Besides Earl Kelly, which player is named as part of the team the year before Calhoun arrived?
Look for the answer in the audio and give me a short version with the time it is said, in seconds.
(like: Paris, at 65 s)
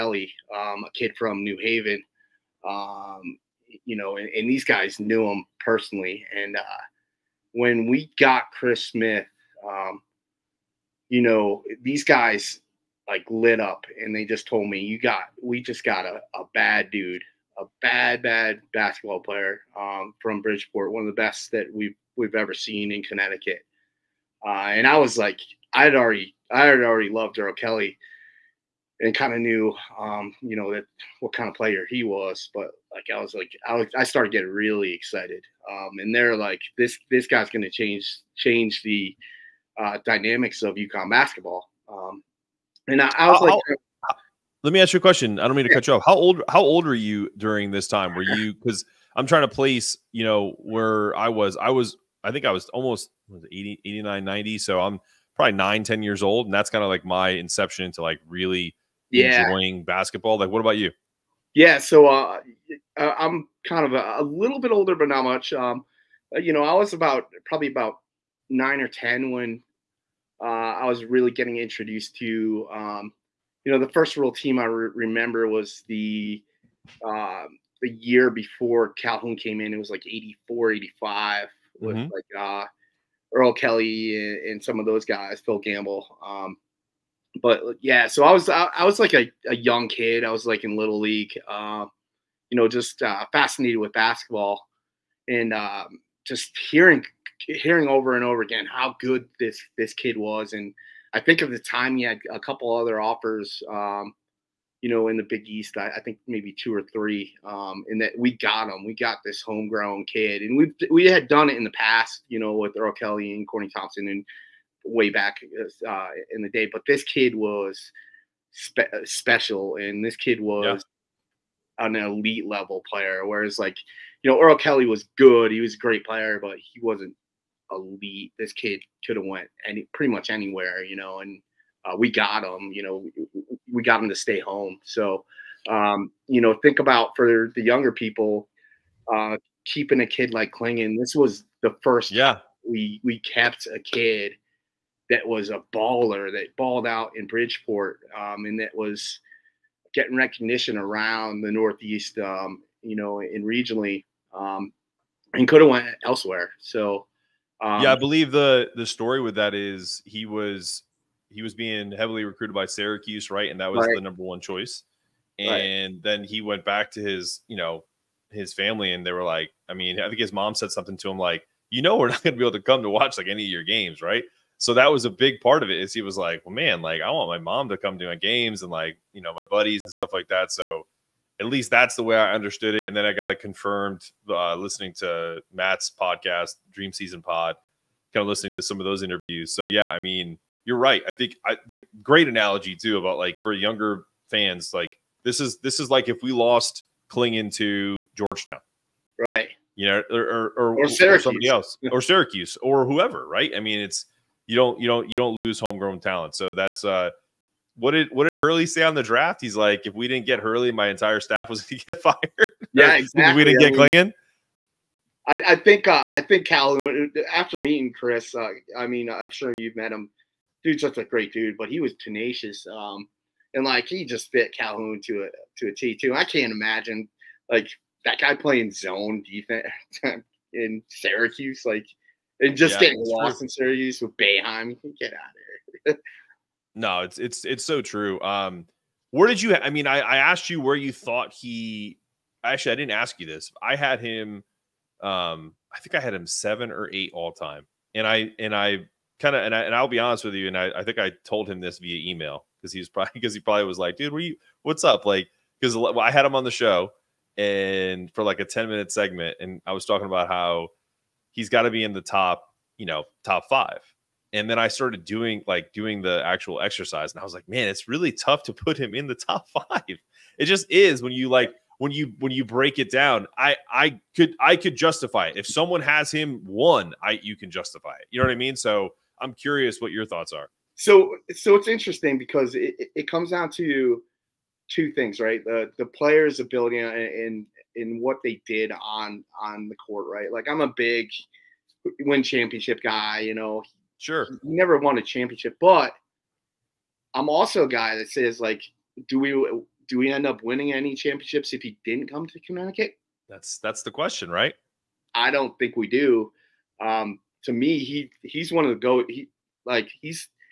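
Phil Gamble, at 85 s.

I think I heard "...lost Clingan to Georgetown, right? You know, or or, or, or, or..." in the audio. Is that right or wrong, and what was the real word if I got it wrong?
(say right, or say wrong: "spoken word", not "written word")
right.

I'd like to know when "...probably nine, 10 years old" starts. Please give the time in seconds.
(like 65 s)
55 s.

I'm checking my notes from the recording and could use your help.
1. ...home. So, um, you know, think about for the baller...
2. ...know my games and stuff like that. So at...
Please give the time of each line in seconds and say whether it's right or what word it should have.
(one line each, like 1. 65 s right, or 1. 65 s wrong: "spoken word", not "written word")
1. 134 s wrong: "younger", not "baller"
2. 179 s wrong: "buddies", not "games".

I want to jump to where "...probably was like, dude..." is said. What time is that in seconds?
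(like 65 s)
253 s.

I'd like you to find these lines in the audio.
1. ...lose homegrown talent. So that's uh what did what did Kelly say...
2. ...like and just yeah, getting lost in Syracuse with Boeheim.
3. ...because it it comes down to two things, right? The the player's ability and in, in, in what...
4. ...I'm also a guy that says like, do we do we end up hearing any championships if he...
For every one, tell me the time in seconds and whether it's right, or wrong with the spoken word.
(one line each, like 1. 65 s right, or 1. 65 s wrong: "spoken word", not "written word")
1. 205 s wrong: "Hurley", not "Kelly"
2. 231 s right
3. 282 s right
4. 297 s wrong: "winning", not "hearing".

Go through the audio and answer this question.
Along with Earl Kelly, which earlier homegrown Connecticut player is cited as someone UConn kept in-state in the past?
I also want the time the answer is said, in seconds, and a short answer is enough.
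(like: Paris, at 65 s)
Corny Thompson, at 113 s.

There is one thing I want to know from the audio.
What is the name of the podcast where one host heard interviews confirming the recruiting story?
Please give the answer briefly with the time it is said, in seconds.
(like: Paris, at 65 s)
Dream Season Pod, at 186 s.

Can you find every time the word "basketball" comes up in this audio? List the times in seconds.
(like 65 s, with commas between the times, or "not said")
18 s, 41 s, 59 s, 94 s.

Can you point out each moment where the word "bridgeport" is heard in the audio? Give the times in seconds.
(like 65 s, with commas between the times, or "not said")
20 s, 147 s.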